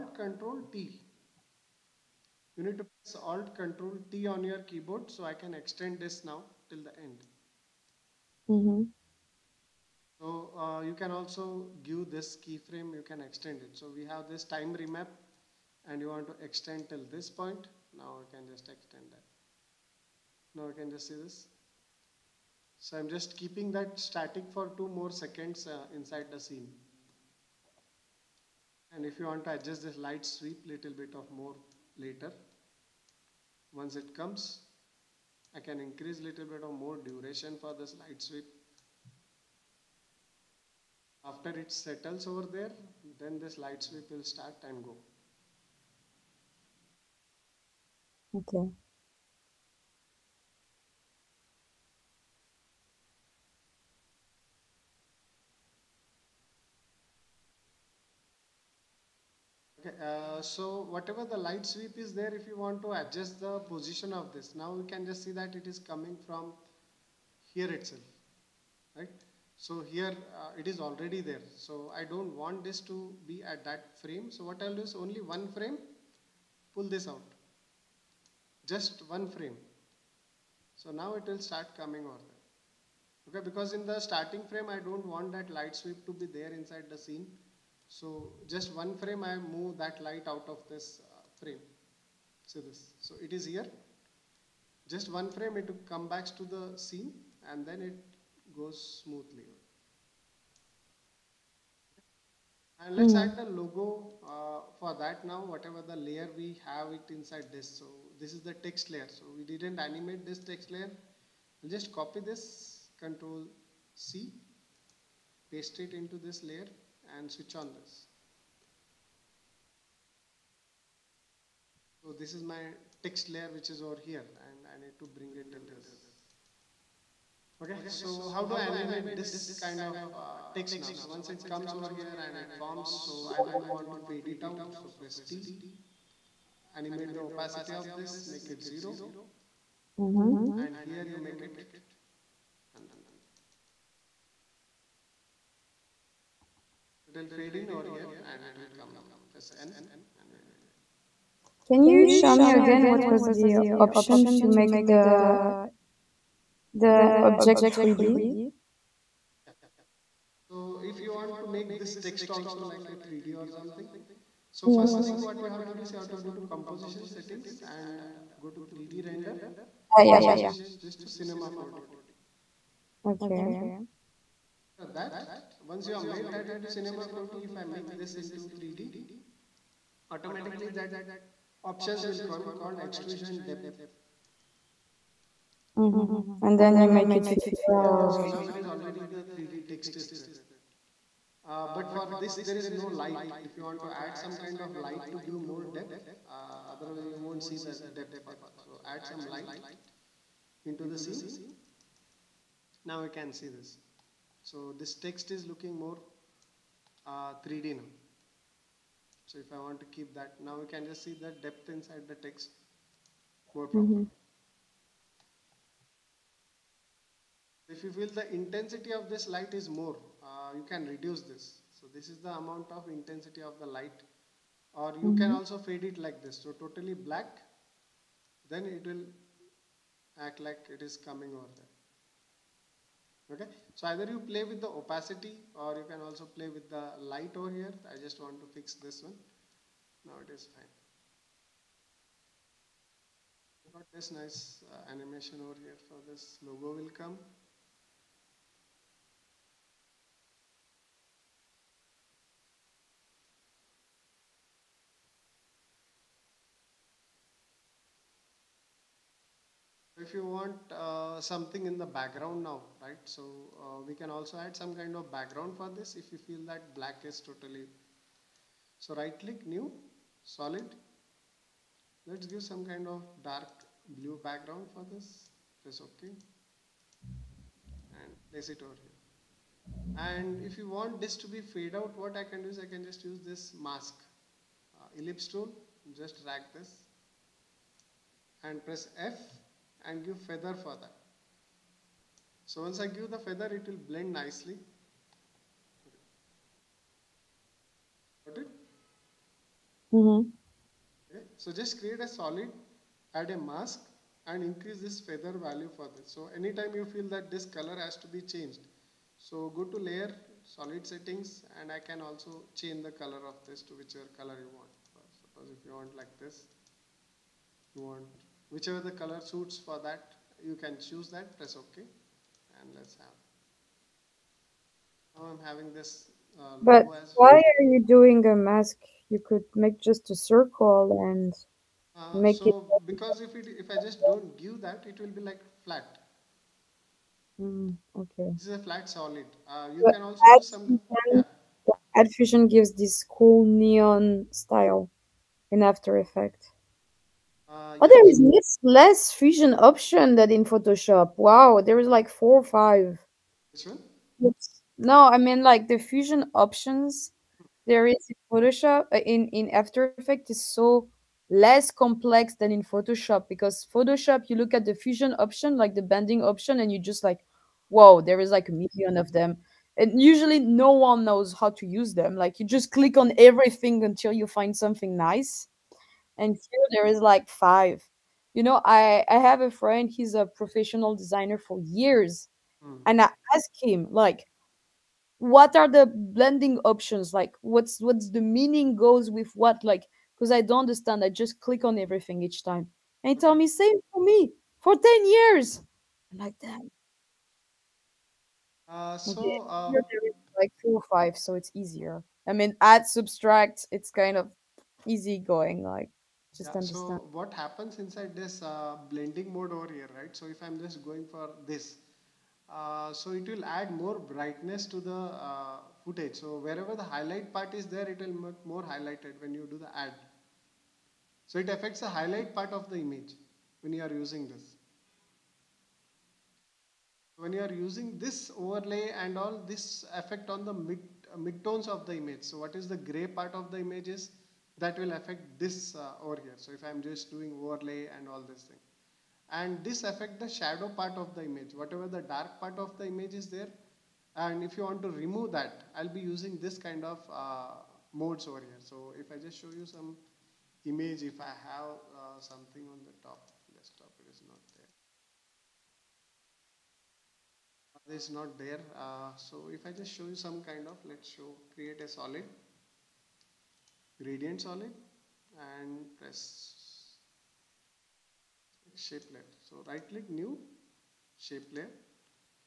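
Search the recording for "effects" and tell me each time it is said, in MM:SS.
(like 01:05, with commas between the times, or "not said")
05:45, 05:59, 07:09.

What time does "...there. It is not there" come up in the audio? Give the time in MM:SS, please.
07:37.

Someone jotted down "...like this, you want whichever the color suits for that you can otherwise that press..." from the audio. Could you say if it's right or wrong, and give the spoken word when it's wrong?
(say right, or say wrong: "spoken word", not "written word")
wrong: "choose", not "otherwise".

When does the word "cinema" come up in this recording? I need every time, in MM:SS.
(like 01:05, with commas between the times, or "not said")
02:51, 02:56.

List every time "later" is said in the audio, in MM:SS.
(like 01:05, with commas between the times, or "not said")
00:31.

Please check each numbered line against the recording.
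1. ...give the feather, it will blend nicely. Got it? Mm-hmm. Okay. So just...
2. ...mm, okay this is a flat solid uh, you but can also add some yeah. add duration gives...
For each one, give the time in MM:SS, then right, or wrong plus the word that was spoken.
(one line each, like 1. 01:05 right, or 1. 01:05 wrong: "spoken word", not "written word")
1. 04:52 right
2. 05:37 wrong: "fusion", not "duration".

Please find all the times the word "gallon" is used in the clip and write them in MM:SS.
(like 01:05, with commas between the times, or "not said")
not said.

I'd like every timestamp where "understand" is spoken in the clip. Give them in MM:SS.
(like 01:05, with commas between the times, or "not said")
06:30, 06:46.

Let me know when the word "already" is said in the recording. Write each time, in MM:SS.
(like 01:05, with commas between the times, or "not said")
01:10, 03:08.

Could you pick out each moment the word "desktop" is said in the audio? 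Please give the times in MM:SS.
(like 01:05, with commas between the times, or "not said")
07:33.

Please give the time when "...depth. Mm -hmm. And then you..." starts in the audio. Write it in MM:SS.
03:03.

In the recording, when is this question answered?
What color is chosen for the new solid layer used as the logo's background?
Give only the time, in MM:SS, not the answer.
04:33.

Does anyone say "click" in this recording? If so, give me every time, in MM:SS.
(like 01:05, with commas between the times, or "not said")
04:29, 06:12, 06:31, 07:49.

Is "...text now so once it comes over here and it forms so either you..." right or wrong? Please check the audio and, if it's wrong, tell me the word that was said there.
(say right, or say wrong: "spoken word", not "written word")
right.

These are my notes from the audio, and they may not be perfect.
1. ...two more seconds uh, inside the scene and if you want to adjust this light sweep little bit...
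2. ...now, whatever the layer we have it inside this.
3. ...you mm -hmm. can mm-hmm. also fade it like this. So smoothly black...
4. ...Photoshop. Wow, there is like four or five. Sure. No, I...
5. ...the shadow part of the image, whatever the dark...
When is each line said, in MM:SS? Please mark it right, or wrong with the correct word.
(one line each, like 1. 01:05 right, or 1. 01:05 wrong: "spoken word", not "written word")
1. 00:24 right
2. 01:45 right
3. 03:44 wrong: "totally", not "smoothly"
4. 05:50 right
5. 07:20 right.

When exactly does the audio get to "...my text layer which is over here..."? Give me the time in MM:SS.
02:02.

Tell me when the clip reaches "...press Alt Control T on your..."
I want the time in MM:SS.
00:02.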